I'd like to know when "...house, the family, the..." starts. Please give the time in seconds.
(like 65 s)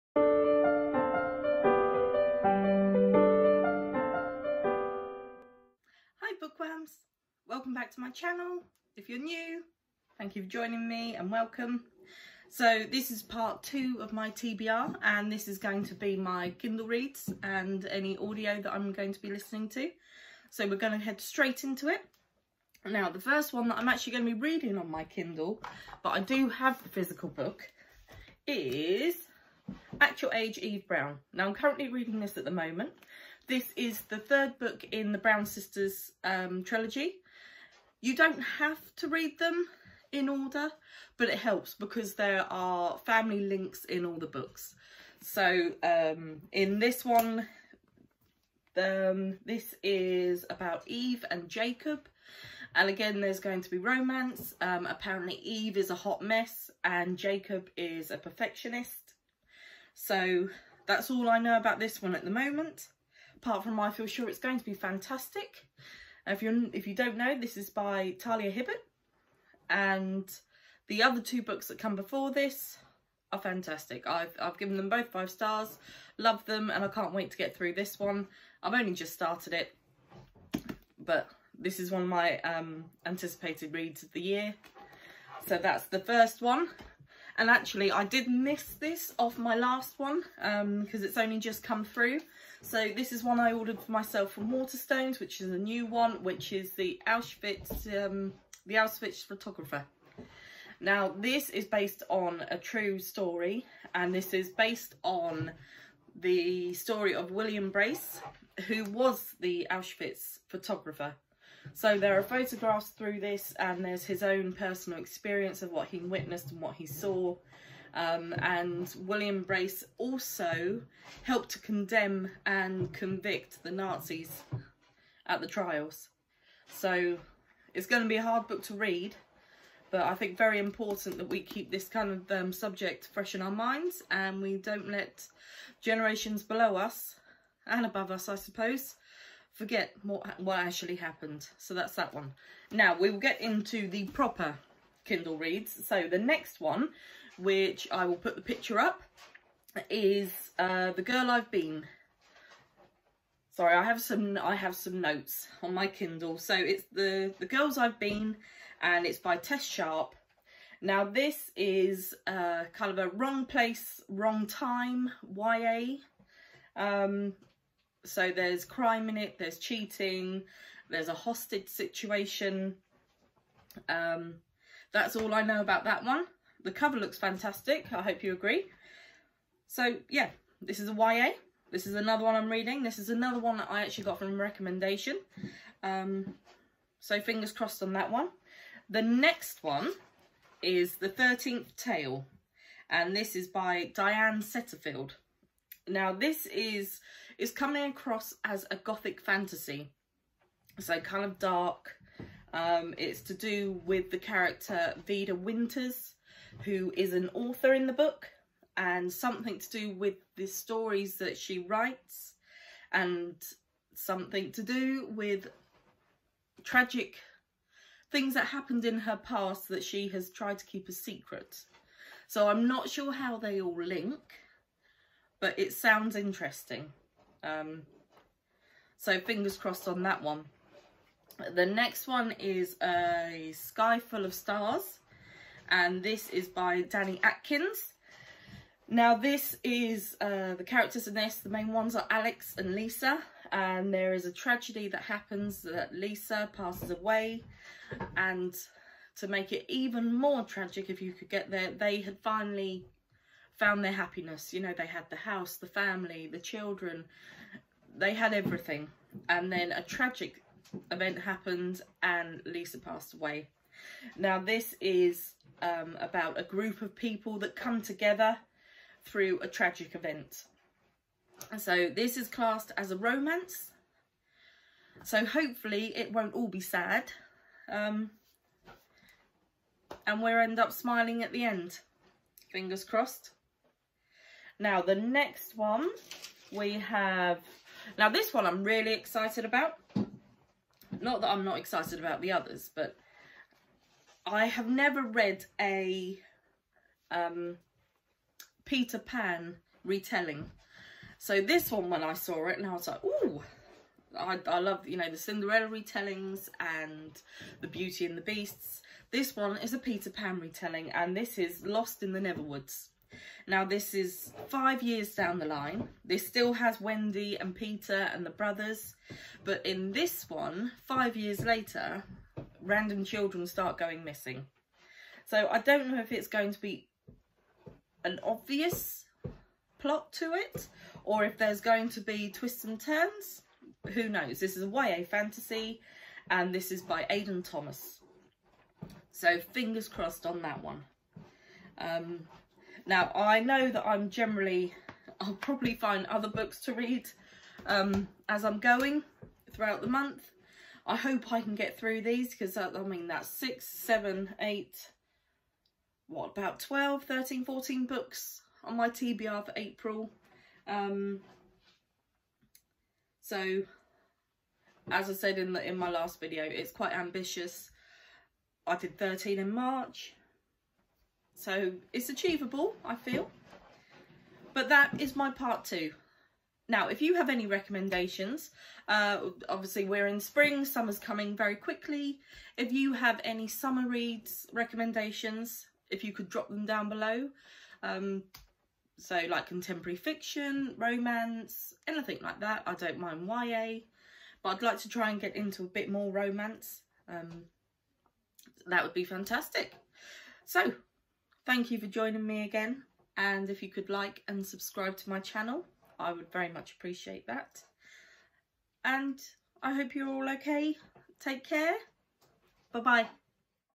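255 s.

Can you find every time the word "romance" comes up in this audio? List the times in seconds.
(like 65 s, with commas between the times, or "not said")
53 s, 272 s, 390 s, 396 s.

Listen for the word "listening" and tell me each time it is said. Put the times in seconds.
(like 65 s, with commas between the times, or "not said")
19 s.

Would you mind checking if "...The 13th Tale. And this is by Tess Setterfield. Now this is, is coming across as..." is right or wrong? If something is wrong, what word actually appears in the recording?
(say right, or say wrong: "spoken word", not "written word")
wrong: "Diane", not "Tess".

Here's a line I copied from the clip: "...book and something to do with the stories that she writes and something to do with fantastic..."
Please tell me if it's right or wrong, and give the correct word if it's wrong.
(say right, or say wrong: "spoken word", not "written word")
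wrong: "tragic", not "fantastic".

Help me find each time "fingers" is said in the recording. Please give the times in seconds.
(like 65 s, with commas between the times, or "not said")
187 s, 229 s, 282 s, 339 s.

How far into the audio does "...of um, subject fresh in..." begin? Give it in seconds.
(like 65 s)
132 s.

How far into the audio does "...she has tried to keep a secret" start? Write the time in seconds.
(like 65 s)
219 s.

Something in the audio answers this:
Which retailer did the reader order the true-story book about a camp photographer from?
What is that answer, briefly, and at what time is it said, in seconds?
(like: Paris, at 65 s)
Waterstones, at 94 s.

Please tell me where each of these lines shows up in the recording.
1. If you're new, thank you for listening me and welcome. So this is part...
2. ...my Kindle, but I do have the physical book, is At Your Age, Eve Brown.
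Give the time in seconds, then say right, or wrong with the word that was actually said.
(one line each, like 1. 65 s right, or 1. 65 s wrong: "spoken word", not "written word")
1. 8 s wrong: "joining", not "listening"
2. 24 s right.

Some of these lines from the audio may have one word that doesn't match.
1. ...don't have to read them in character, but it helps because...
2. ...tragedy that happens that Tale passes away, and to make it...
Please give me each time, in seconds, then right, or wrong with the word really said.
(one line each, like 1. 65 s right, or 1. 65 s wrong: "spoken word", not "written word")
1. 38 s wrong: "order", not "character"
2. 244 s wrong: "Lisa", not "Tale".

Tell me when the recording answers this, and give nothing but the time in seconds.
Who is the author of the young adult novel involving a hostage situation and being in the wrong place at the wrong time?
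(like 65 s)
159 s.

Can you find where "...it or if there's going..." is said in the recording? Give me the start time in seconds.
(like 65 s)
330 s.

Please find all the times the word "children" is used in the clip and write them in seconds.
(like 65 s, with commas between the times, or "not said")
256 s, 323 s.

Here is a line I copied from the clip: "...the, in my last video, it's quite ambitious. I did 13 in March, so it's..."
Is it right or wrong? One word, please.
right.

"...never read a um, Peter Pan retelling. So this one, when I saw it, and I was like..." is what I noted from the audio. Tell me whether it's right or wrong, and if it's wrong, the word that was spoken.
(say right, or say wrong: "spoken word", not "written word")
right.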